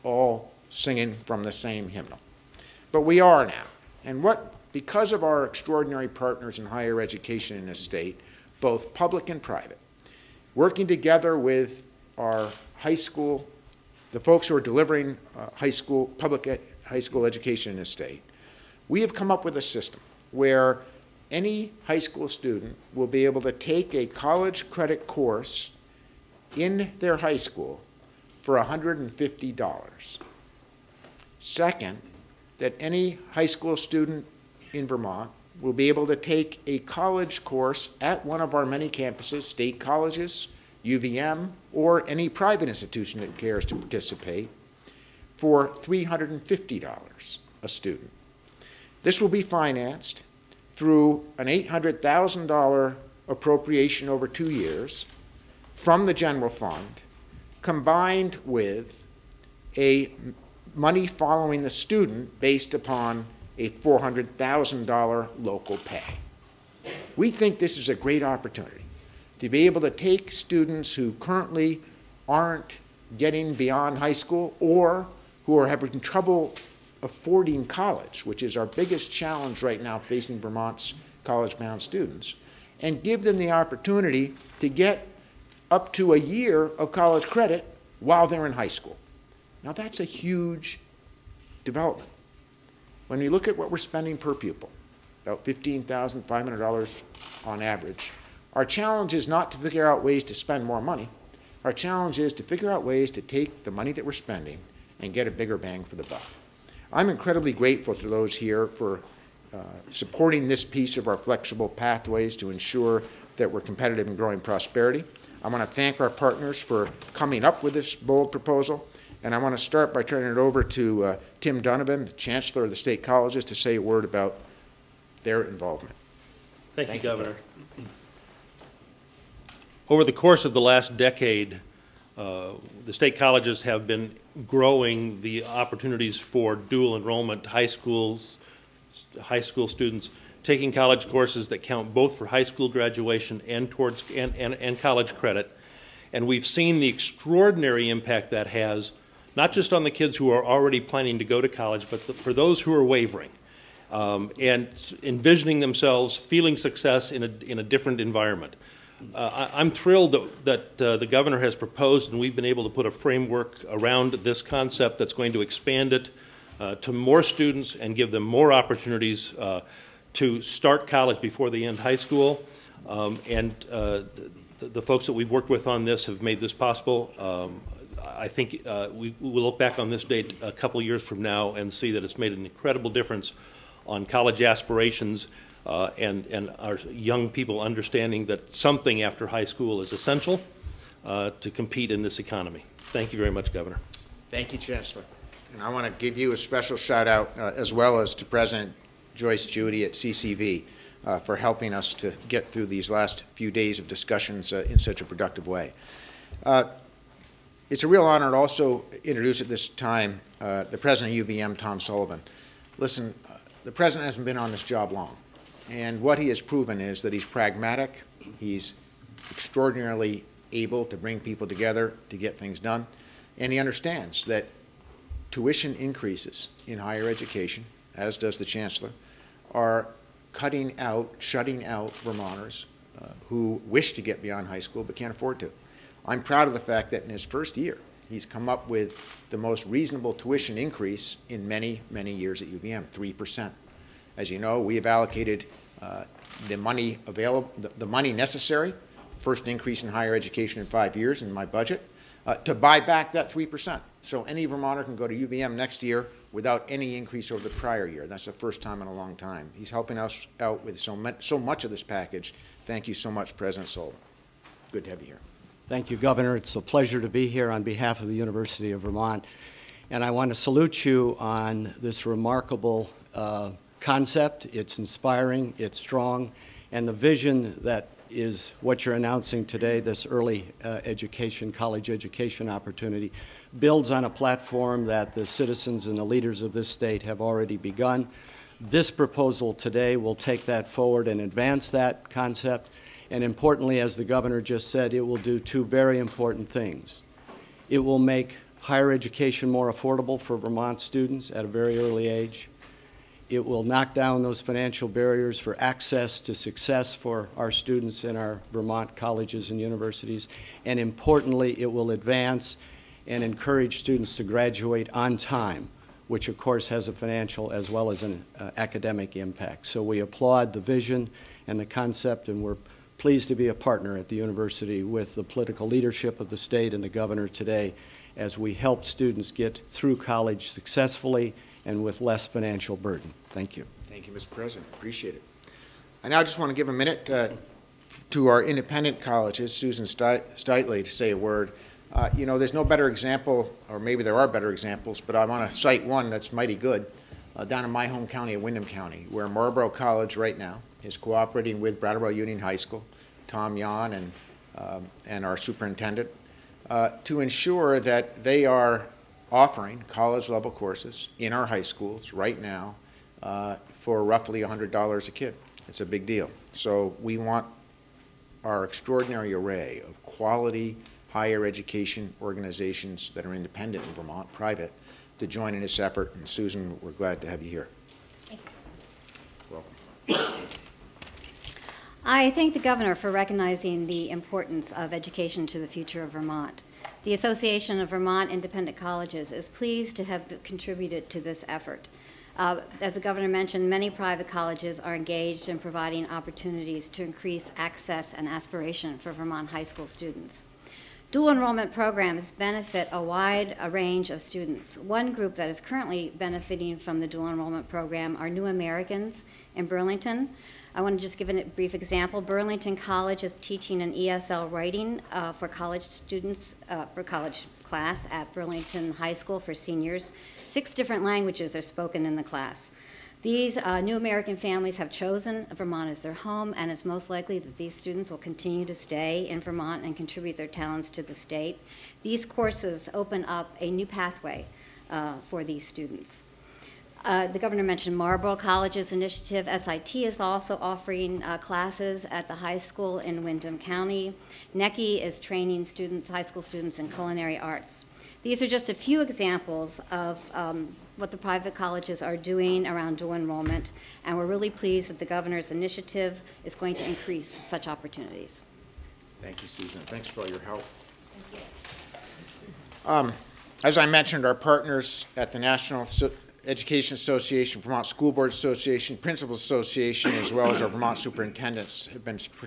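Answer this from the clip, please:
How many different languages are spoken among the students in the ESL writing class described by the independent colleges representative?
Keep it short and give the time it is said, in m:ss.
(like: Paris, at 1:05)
6, at 7:00.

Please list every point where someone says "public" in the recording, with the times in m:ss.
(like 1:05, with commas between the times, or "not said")
0:08, 0:16.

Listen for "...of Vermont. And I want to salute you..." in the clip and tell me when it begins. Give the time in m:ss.
4:28.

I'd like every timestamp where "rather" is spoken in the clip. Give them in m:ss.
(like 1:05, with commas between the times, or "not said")
not said.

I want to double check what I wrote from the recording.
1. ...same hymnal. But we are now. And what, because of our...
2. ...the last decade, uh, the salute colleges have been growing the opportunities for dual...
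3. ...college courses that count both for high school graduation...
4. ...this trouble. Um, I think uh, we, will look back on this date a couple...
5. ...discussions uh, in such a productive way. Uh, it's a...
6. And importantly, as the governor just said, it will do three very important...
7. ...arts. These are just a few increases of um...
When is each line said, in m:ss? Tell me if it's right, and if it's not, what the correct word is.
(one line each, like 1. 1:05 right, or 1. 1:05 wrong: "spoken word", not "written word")
1. 0:01 right
2. 2:10 wrong: "state", not "salute"
3. 2:20 right
4. 2:56 wrong: "possible", not "trouble"
5. 3:23 right
6. 4:53 wrong: "two", not "three"
7. 7:27 wrong: "examples", not "increases".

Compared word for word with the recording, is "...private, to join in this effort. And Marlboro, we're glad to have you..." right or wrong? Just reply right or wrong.
wrong.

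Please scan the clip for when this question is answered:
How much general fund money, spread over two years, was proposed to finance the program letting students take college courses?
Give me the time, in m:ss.
0:51.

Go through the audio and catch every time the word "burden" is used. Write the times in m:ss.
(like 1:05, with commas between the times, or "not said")
5:32.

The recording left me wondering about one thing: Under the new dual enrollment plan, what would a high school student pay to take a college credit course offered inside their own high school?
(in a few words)
$150.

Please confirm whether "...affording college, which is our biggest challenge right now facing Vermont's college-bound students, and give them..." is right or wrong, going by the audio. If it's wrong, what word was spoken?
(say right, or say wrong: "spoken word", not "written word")
right.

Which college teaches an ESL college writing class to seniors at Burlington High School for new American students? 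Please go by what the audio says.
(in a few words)
Burlington College.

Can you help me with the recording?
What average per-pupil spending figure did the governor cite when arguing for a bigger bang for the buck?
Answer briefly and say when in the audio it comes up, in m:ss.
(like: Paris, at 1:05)
$15,500, at 1:35.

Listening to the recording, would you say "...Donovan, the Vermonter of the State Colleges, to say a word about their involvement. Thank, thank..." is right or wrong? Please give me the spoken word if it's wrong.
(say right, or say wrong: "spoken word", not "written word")
wrong: "Chancellor", not "Vermonter".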